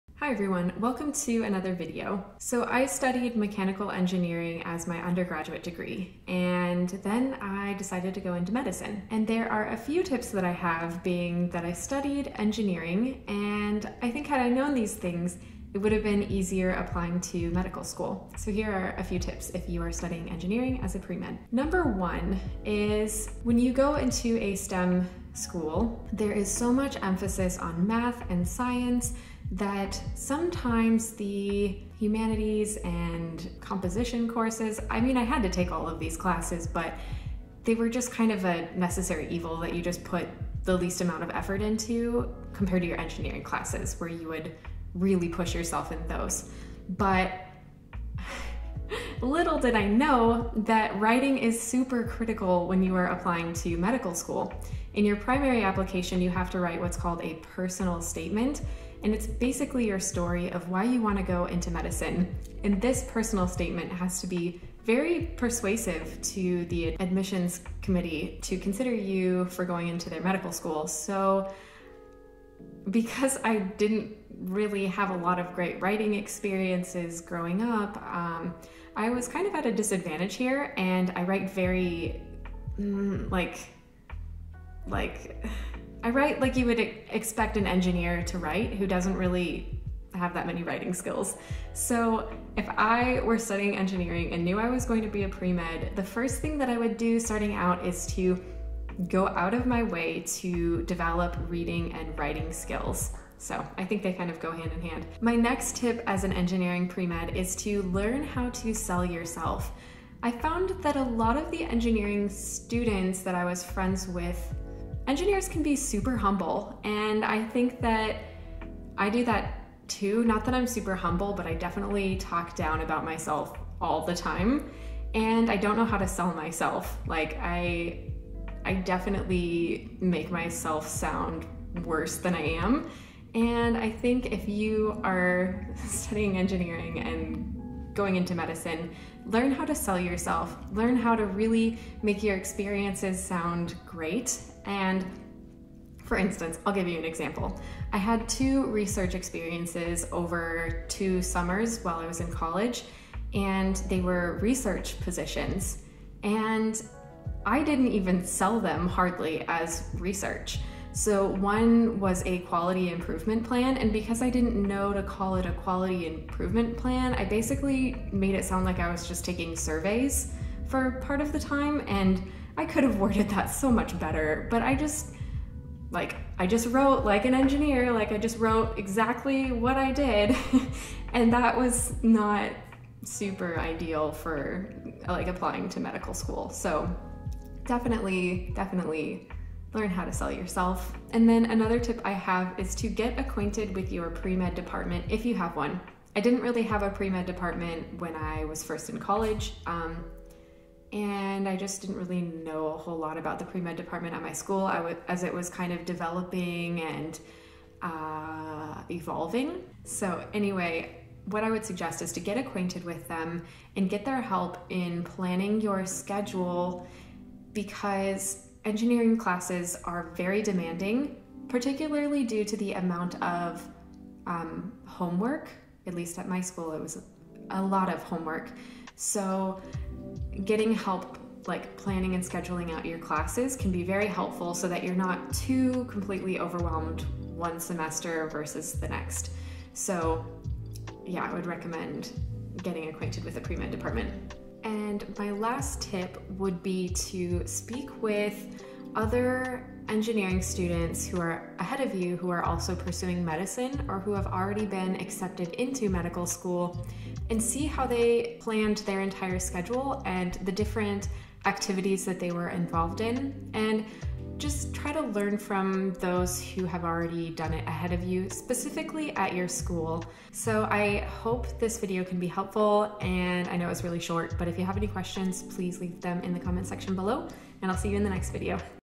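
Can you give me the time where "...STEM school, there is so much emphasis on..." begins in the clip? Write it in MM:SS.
00:24.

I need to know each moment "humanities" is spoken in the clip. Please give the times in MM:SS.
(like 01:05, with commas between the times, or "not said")
00:31.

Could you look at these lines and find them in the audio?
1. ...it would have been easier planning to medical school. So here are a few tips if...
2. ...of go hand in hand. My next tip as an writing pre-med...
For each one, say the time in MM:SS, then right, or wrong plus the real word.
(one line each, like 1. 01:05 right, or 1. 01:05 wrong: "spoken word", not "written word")
1. 00:15 wrong: "applying", not "planning"
2. 01:44 wrong: "engineering", not "writing".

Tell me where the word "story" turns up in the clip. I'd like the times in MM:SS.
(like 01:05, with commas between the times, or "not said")
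00:59.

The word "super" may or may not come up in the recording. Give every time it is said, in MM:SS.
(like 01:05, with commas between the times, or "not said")
00:51, 01:55, 02:00, 03:03.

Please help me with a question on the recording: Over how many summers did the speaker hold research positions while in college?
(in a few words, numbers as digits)
2.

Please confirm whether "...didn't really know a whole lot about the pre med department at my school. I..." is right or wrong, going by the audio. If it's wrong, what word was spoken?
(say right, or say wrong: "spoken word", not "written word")
right.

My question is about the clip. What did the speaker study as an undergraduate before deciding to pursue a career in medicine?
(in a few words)
Mechanical engineering.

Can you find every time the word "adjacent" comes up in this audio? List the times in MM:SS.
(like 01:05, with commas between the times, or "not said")
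not said.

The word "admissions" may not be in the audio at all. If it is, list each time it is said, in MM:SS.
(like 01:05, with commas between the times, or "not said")
01:06.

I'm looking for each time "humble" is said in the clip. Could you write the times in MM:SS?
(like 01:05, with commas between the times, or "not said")
01:56, 02:00.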